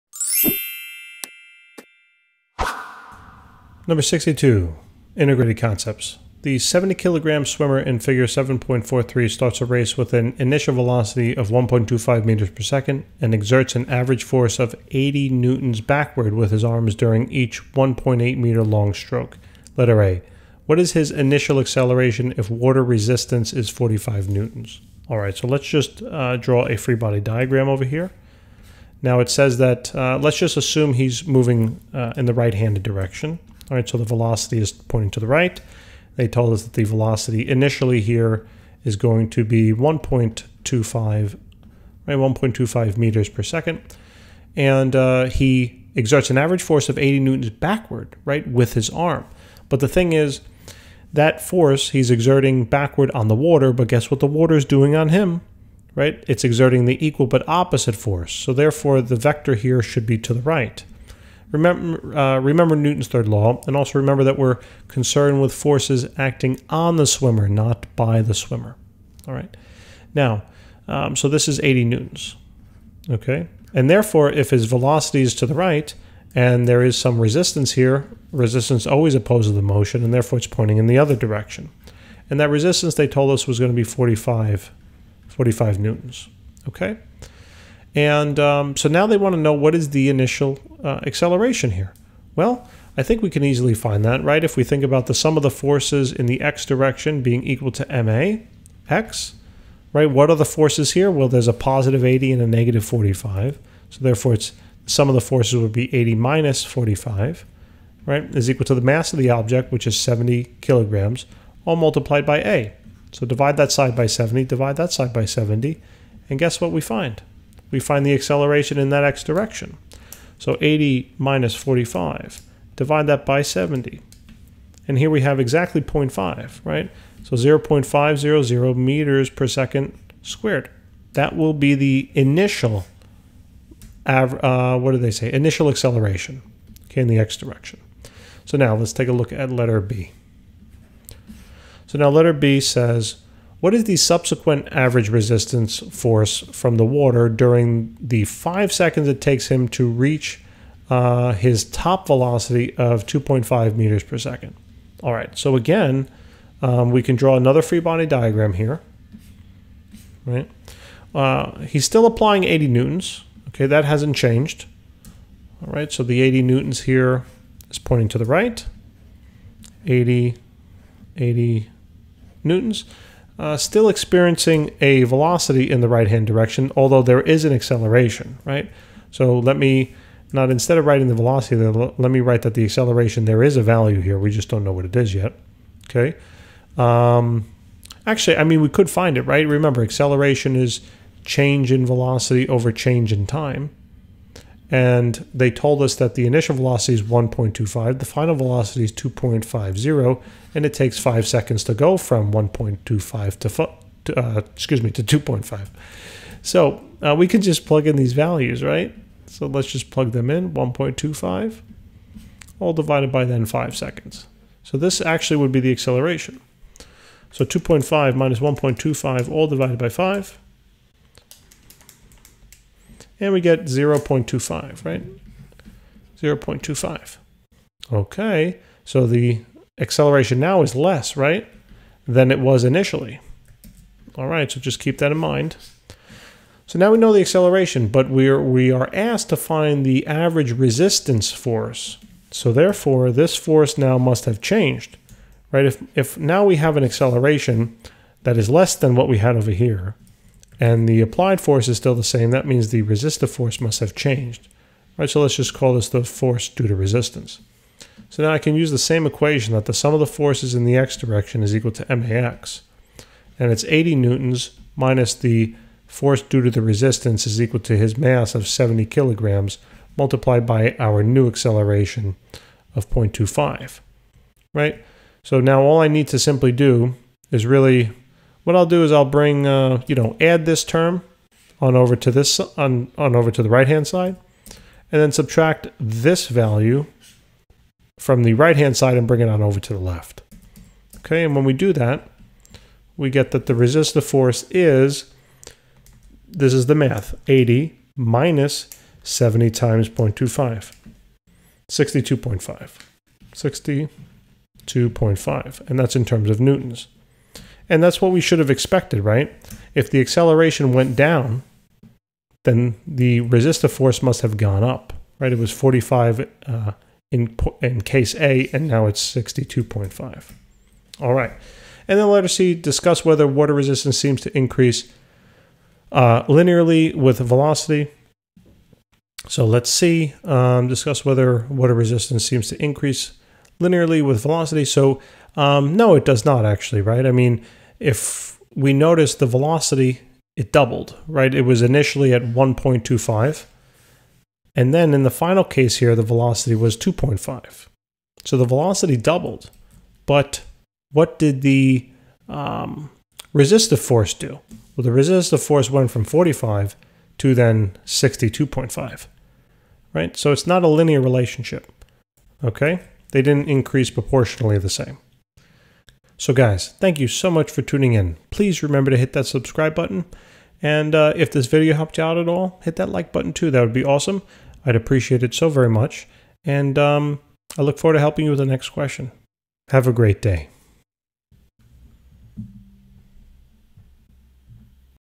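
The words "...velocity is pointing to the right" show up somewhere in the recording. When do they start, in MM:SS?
00:34.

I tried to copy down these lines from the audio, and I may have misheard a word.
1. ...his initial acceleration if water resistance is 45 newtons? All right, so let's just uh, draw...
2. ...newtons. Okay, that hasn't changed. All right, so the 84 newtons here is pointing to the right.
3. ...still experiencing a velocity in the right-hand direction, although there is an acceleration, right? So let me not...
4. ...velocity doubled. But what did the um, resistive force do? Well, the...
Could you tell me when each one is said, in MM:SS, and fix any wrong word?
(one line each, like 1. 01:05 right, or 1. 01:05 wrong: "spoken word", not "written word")
1. 00:20 right
2. 02:42 wrong: "80", not "84"
3. 02:53 right
4. 05:48 right.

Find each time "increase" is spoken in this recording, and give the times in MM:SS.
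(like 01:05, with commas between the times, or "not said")
05:24, 05:32, 06:03.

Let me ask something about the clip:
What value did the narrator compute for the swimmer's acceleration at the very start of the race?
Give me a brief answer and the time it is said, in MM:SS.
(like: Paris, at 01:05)
0.500 m/s², at 02:07.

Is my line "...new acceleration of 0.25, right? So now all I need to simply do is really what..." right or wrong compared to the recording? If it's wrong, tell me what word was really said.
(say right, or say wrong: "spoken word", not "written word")
right.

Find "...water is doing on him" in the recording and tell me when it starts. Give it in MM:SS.
00:54.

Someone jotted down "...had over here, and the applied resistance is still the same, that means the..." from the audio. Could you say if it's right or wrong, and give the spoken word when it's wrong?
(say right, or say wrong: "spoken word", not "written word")
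wrong: "force", not "resistance".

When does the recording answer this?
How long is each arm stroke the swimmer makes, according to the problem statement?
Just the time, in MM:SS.
00:17.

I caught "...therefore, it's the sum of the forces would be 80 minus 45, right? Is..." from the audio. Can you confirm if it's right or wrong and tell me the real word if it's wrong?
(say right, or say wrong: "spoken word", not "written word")
right.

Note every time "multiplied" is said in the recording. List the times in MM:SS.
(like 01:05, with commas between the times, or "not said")
01:51, 04:29.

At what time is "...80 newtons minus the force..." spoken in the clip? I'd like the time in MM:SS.
04:23.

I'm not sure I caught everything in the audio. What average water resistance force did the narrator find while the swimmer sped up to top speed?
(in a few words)
62.5 N.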